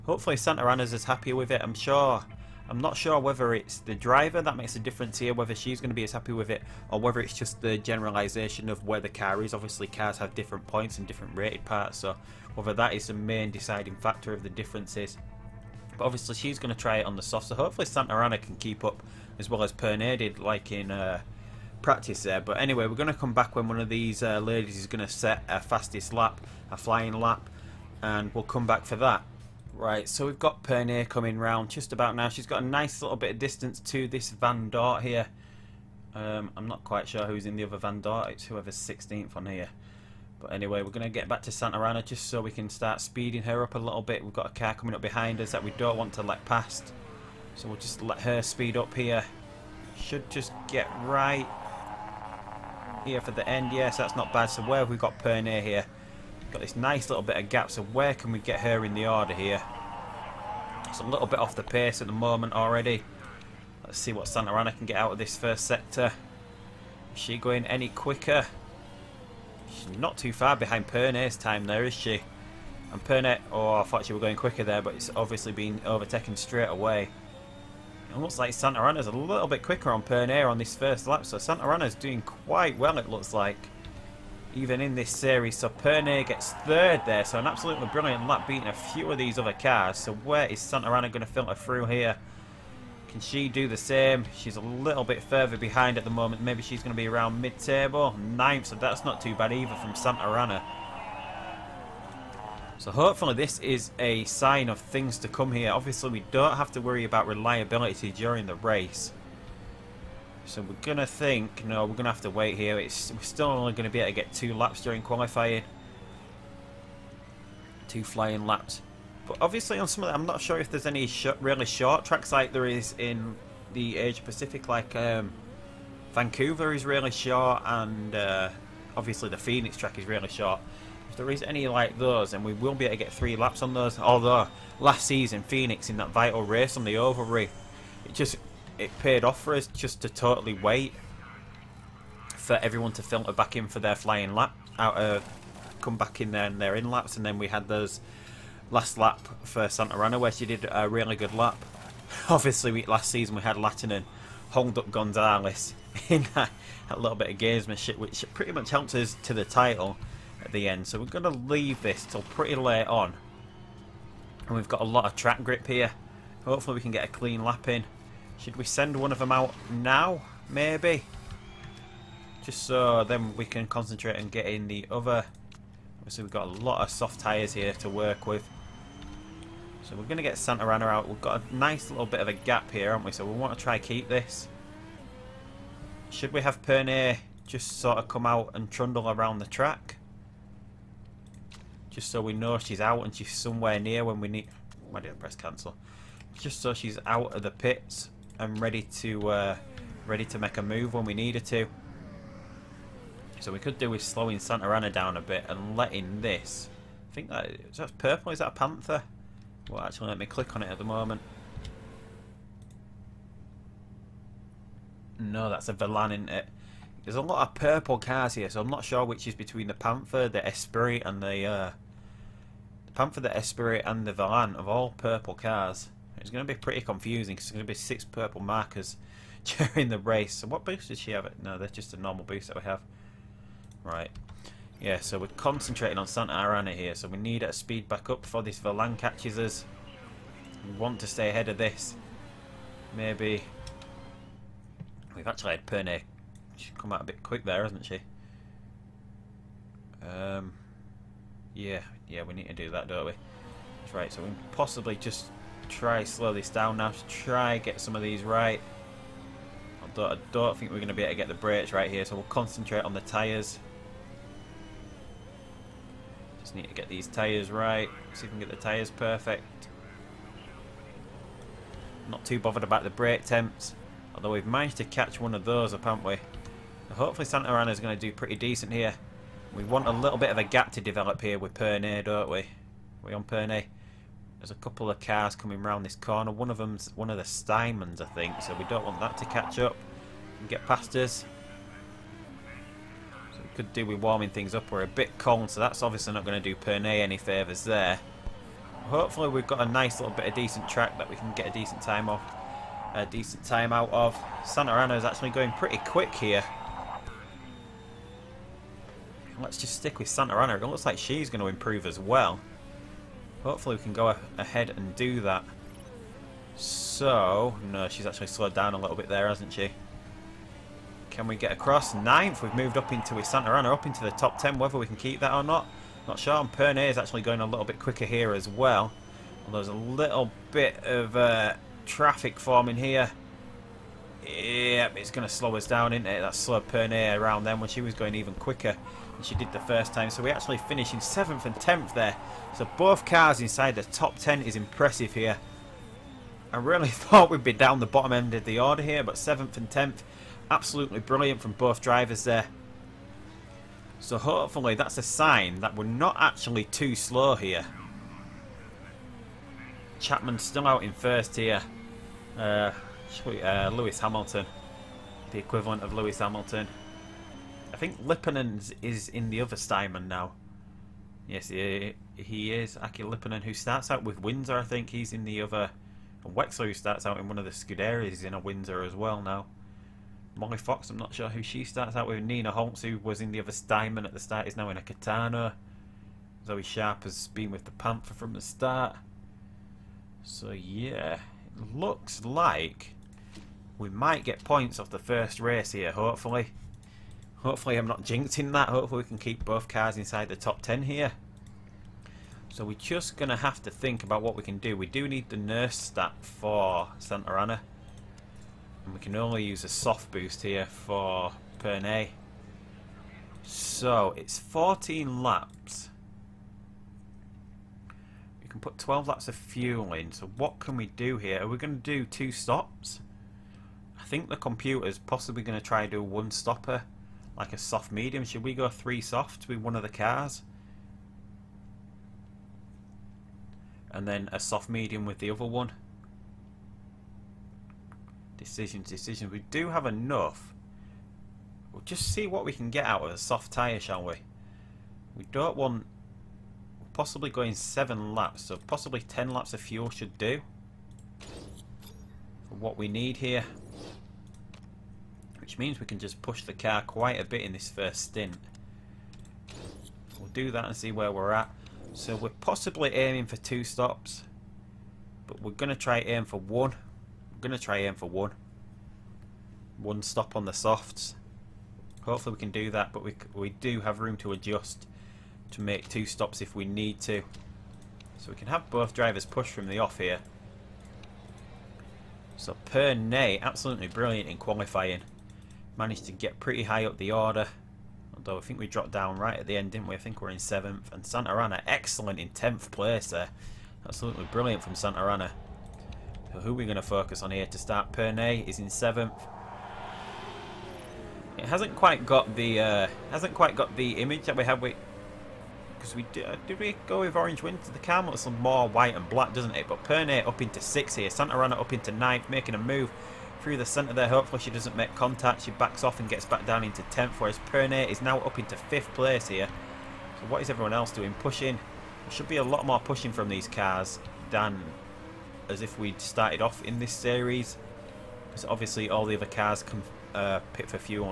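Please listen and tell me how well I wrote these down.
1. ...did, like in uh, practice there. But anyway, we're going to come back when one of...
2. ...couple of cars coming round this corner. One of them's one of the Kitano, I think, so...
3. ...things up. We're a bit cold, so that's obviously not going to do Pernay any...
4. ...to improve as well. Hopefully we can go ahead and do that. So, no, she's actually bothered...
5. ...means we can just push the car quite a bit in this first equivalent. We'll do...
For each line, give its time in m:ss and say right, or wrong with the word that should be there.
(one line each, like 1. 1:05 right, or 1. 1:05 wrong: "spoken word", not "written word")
1. 0:20 right
2. 4:44 wrong: "Steinmans", not "Kitano"
3. 4:54 right
4. 5:11 wrong: "slowed", not "bothered"
5. 7:35 wrong: "stint", not "equivalent".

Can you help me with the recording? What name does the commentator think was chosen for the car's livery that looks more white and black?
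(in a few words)
Orange Winter.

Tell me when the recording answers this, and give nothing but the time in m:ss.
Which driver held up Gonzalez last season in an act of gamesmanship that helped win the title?
2:33.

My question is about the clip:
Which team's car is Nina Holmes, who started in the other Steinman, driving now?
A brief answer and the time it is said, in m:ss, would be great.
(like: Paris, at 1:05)
Kitano, at 6:24.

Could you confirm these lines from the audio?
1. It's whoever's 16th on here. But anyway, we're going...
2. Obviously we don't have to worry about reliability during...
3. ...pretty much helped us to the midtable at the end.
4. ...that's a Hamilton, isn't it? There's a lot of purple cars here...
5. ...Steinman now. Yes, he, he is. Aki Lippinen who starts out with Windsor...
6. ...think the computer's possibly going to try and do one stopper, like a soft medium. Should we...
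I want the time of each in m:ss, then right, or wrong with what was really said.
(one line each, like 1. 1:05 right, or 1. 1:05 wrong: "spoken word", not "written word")
1. 0:38 right
2. 1:45 right
3. 2:38 wrong: "title", not "midtable"
4. 3:35 wrong: "Velan", not "Hamilton"
5. 6:09 right
6. 7:04 right.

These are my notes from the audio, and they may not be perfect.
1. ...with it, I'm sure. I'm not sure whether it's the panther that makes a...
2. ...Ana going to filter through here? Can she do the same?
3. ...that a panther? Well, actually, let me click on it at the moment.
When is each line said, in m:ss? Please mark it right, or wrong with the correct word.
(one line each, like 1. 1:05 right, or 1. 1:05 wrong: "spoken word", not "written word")
1. 0:01 wrong: "driver", not "panther"
2. 1:30 right
3. 3:28 right.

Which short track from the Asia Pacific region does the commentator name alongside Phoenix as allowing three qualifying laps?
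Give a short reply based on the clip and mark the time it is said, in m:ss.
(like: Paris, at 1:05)
Vancouver, at 2:06.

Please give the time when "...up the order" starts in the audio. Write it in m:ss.
8:06.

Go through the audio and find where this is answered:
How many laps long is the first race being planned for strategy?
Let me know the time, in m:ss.
6:54.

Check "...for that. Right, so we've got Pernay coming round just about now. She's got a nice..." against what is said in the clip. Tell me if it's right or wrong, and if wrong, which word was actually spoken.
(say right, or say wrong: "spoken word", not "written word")
right.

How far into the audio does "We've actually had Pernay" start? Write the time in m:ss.
4:05.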